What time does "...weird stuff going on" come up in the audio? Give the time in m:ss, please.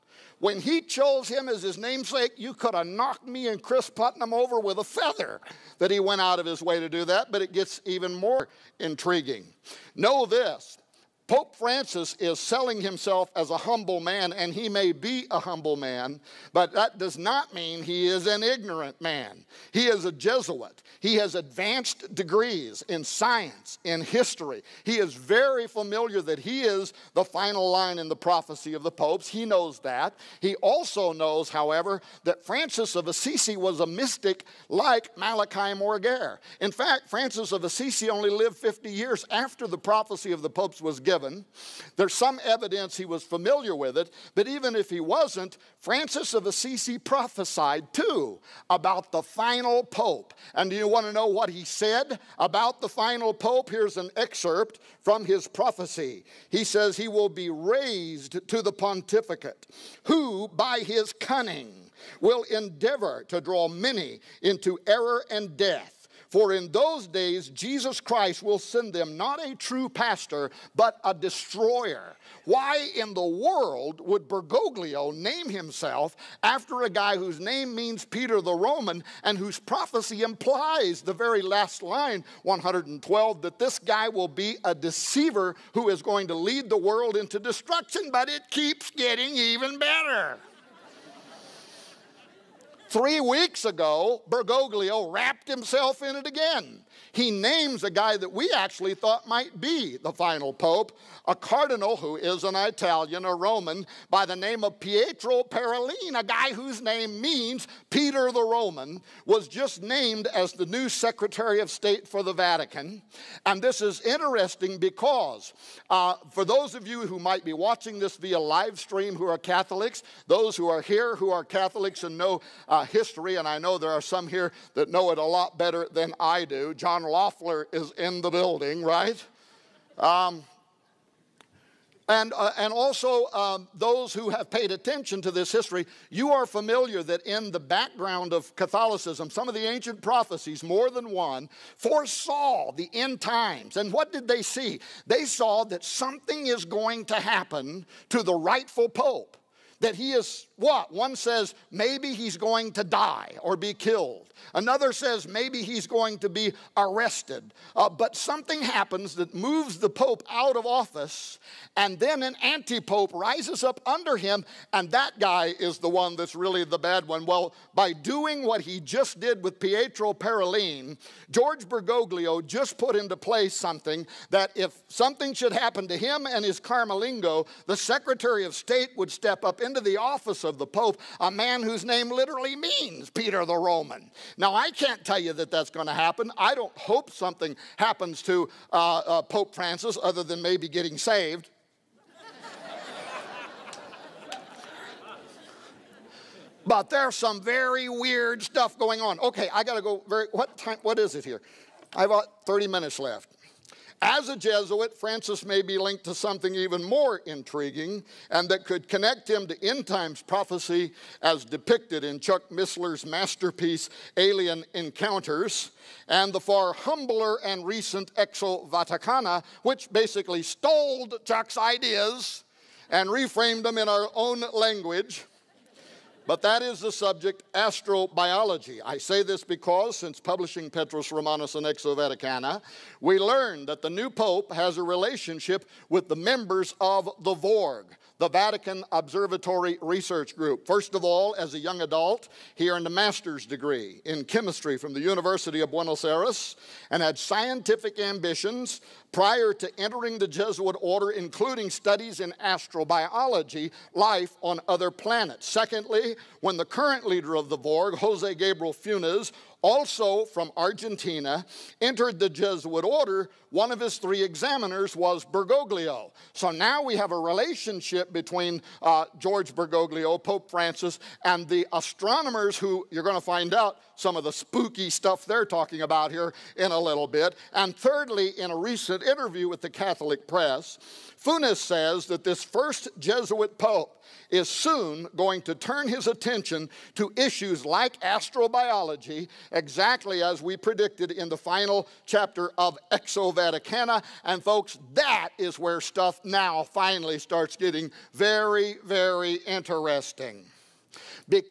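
3:17.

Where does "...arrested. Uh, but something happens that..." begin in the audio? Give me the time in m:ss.
2:36.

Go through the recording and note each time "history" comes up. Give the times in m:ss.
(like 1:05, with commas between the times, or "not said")
0:24, 2:02, 2:15.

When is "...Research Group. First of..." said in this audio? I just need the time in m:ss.
3:59.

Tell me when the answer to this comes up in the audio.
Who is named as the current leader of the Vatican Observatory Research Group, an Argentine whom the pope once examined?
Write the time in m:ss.
4:17.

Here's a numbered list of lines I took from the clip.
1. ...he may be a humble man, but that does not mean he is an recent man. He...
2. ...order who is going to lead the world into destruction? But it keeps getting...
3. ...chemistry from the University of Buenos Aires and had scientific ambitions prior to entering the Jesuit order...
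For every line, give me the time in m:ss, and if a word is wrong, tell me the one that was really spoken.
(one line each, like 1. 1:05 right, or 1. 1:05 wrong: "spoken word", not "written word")
1. 0:14 wrong: "ignorant", not "recent"
2. 1:24 wrong: "deceiver", not "order"
3. 4:04 right.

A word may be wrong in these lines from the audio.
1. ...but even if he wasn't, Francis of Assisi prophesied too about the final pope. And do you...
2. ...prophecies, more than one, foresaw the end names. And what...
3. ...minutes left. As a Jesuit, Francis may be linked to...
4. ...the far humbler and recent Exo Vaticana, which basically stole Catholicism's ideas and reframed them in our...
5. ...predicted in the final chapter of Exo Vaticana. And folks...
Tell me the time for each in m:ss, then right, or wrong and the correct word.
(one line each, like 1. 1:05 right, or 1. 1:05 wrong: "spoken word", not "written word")
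1. 0:44 right
2. 2:20 wrong: "times", not "names"
3. 3:22 right
4. 3:36 wrong: "Chuck", not "Catholicism"
5. 4:50 right.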